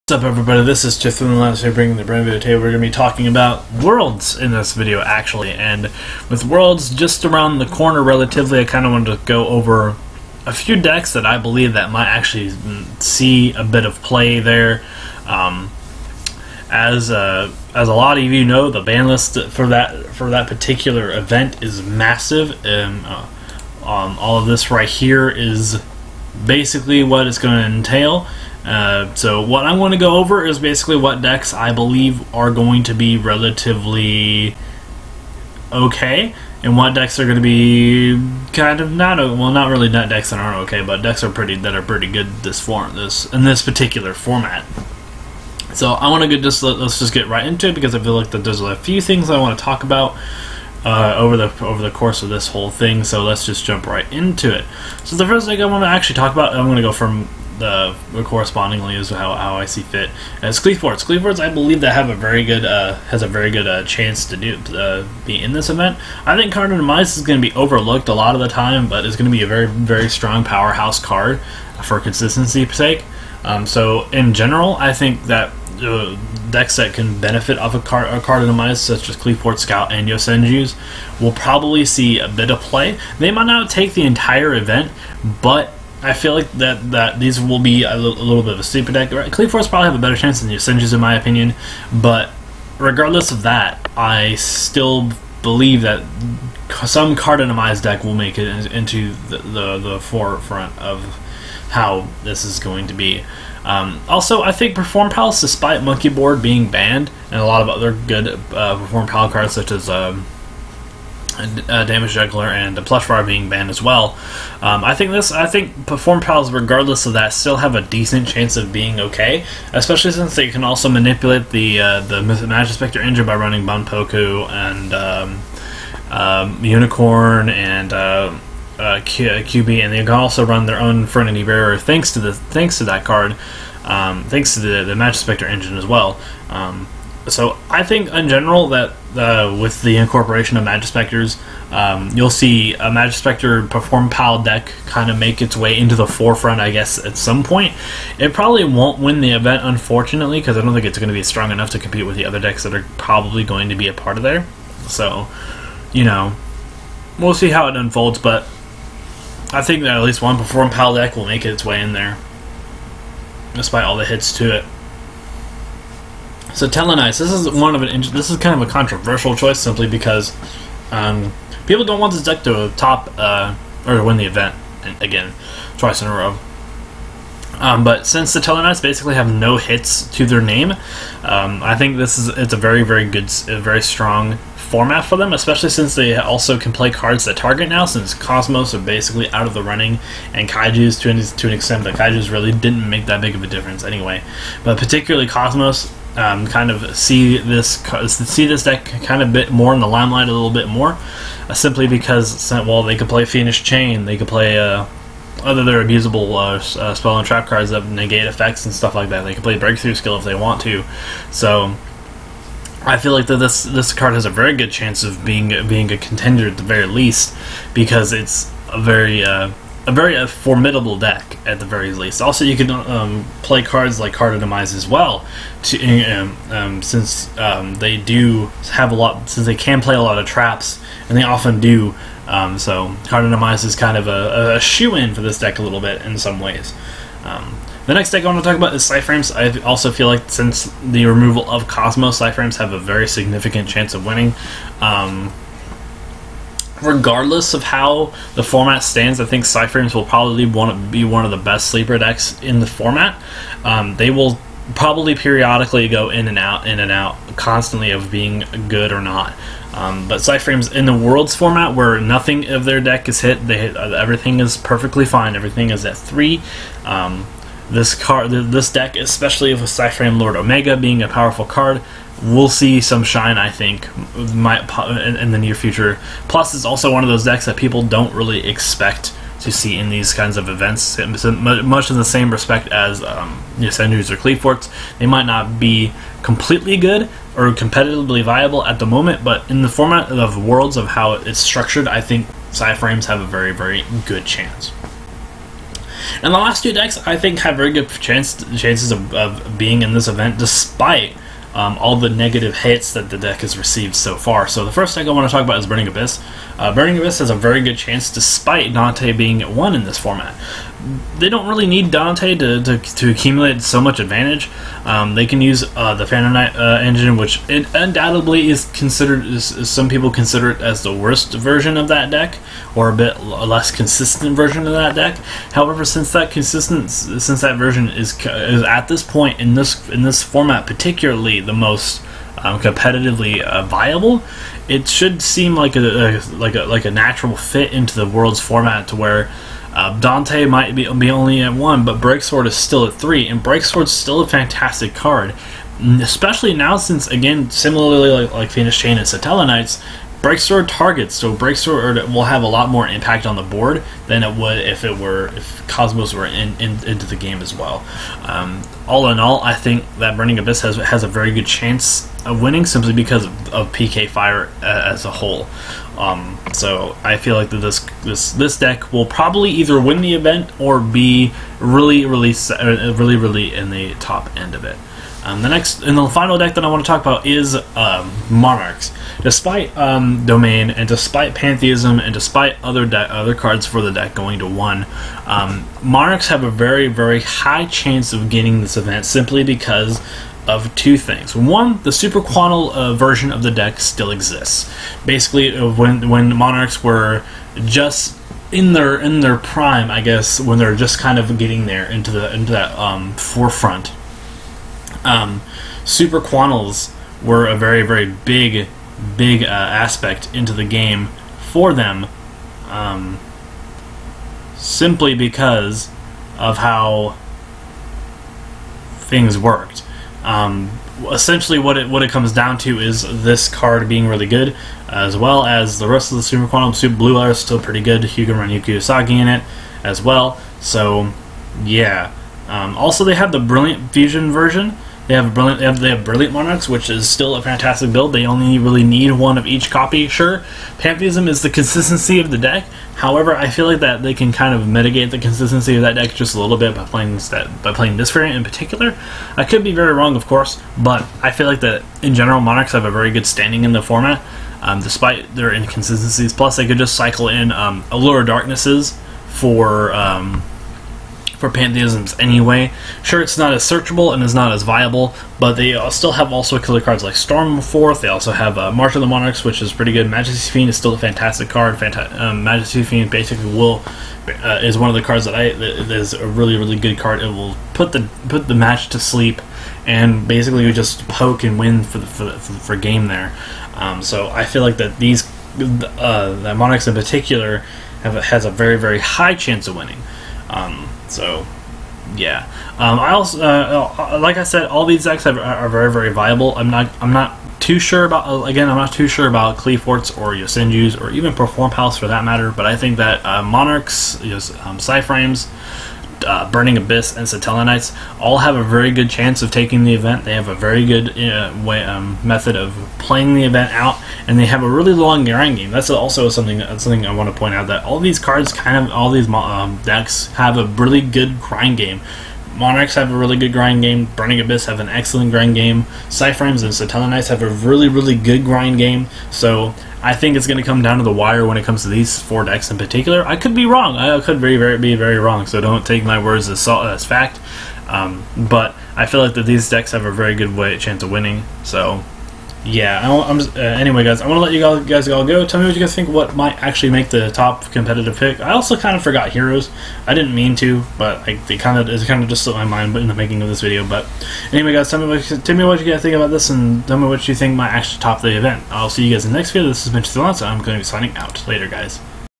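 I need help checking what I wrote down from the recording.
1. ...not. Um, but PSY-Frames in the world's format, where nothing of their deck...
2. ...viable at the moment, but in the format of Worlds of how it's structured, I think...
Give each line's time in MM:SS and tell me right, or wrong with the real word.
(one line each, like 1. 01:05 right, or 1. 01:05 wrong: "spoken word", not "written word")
1. 04:19 right
2. 04:48 right.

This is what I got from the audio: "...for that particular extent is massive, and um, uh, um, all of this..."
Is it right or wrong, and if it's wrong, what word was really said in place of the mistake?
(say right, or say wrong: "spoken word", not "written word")
wrong: "event", not "extent".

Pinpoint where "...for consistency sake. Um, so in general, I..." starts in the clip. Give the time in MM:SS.
01:11.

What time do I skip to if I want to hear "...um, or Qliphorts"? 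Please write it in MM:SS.
04:43.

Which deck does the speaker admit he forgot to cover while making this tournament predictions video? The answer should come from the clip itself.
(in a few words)
Heroes.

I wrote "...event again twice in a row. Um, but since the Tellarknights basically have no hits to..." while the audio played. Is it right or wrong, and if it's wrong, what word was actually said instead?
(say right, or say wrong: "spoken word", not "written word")
right.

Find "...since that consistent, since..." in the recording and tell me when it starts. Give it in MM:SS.
05:25.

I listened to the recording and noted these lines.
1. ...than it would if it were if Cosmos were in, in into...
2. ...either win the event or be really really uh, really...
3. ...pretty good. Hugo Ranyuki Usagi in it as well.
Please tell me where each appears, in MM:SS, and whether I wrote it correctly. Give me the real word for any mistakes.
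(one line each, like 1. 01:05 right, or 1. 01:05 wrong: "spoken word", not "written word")
1. 05:54 right
2. 06:09 right
3. 07:07 right.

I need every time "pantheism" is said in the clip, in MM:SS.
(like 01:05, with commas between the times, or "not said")
06:21, 07:20, 07:41.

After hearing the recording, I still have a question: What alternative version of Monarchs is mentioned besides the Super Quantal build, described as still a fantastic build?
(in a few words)
Brilliant Fusion.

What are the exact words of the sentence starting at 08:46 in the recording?
PSY-Frames and Satellarknights have a really, really good grind game.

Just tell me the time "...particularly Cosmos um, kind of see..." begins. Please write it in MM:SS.
03:14.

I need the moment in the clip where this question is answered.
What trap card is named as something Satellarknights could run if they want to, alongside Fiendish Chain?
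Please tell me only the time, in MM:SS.
03:29.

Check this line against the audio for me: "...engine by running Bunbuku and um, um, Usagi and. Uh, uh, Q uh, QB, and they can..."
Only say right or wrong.
wrong.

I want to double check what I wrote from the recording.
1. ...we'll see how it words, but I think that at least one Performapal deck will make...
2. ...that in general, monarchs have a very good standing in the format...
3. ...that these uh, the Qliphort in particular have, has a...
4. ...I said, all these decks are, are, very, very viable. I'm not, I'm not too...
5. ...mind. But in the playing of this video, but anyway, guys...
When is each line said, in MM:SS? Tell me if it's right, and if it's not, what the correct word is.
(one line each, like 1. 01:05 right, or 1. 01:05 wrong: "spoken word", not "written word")
1. 02:37 wrong: "unfolds", not "words"
2. 07:31 right
3. 08:04 wrong: "Monarchs", not "Qliphort"
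4. 08:14 right
5. 09:12 wrong: "making", not "playing".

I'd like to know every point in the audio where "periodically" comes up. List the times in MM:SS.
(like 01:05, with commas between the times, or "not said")
04:15.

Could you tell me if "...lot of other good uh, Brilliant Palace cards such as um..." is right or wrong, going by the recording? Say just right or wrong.
wrong.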